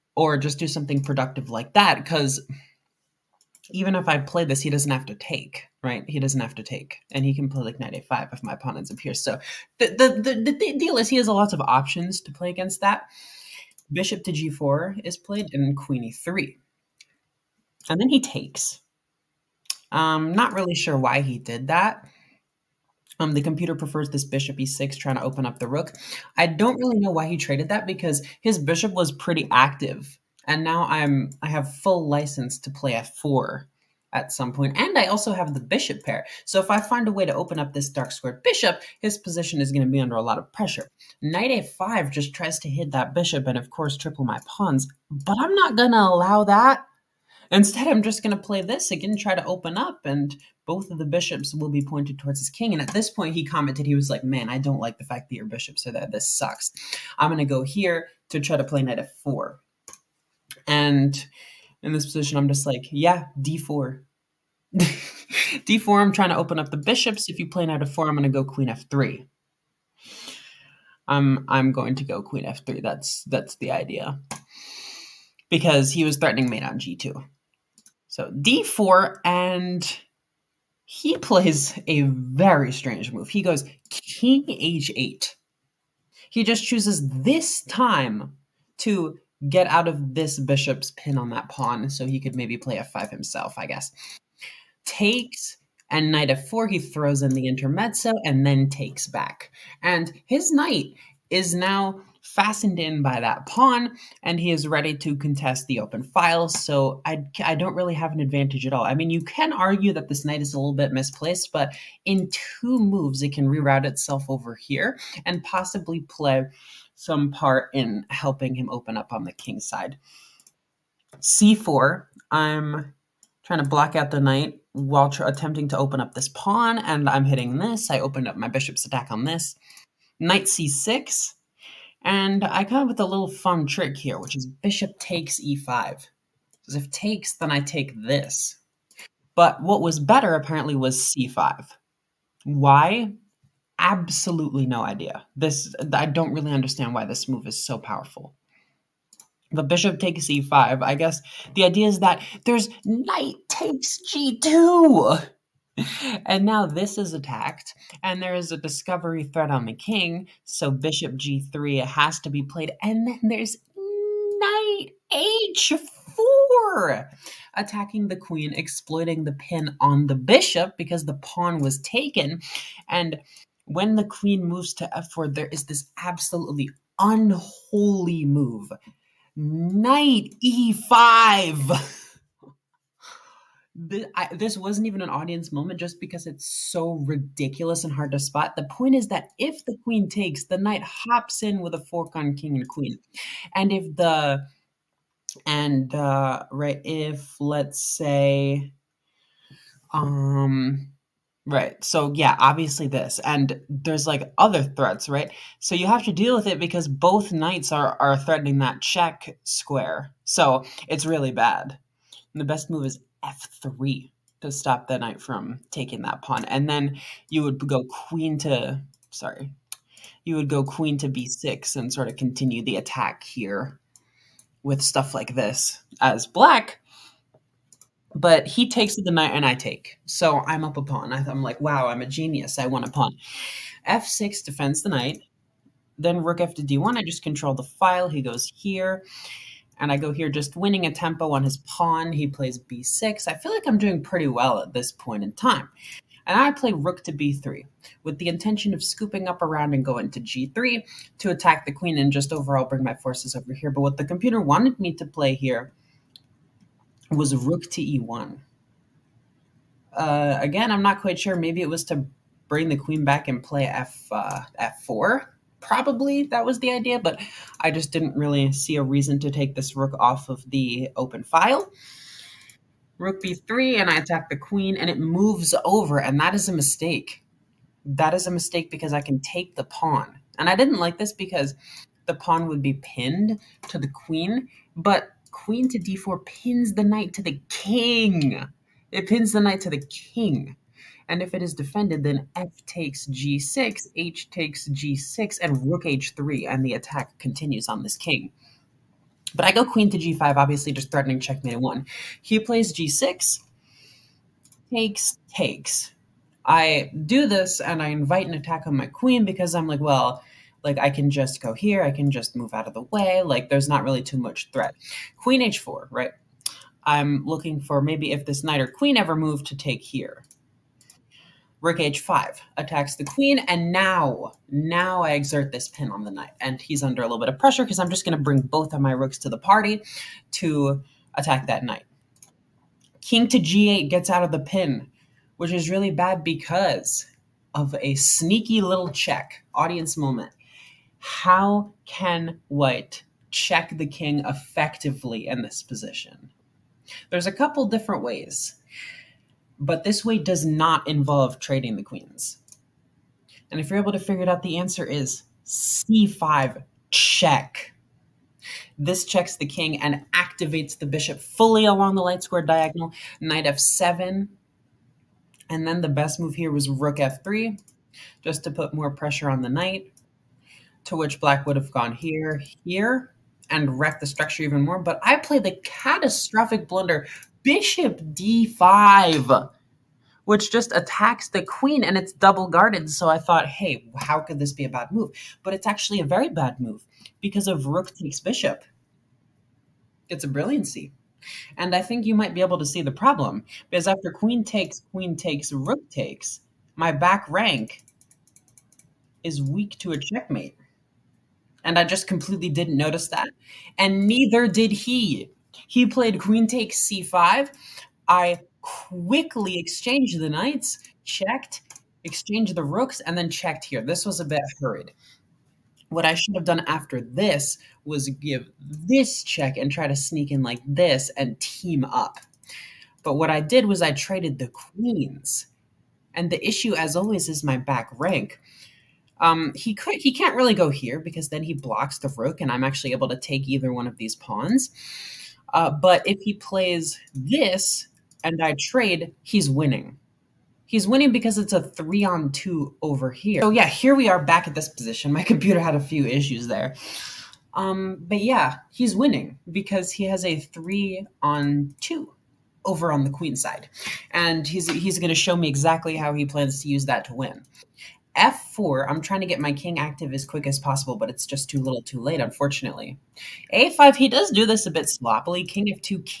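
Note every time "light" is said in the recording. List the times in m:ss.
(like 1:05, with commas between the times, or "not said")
6:02.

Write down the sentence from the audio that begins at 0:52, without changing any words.
And at this point, he commented, he was like, Man, I don't like the fact that your bishops are there.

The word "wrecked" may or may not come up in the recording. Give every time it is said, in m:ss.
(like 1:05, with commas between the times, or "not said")
6:13.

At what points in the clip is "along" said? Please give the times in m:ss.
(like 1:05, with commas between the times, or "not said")
6:01.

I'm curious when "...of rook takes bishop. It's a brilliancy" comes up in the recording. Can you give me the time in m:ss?
6:27.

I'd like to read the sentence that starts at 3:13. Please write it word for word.
And if the, and, uh, right, if let's say, um, Right.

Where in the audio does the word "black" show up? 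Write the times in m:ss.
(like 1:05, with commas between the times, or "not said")
3:46, 6:11.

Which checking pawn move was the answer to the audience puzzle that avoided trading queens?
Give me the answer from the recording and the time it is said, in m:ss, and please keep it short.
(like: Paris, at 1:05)
c5 check, at 5:55.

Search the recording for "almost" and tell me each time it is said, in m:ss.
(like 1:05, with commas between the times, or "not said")
not said.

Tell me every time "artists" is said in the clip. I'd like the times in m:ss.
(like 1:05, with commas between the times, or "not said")
not said.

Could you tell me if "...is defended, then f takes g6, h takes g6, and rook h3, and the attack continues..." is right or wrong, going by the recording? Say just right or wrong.
right.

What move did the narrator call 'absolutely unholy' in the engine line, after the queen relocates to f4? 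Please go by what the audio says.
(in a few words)
Knight e5.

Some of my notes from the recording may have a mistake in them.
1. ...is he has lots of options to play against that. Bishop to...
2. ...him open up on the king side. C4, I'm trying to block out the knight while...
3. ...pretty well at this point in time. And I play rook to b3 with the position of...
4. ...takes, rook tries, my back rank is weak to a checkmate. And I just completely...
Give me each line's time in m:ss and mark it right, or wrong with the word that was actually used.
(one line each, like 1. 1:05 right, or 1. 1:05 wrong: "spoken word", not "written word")
1. 0:10 right
2. 1:58 right
3. 4:04 wrong: "intention", not "position"
4. 6:35 wrong: "takes", not "tries".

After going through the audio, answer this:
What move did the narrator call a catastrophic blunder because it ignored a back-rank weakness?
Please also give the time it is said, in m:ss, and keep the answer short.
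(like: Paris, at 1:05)
Bishop d5, at 6:17.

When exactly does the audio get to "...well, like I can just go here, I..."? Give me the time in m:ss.
5:09.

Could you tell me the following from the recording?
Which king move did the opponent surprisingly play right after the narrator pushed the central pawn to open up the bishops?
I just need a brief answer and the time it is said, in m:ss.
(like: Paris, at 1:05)
King h8, at 1:23.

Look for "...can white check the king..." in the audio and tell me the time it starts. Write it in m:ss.
5:41.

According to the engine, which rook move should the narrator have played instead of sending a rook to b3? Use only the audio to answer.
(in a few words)
Rook to e1.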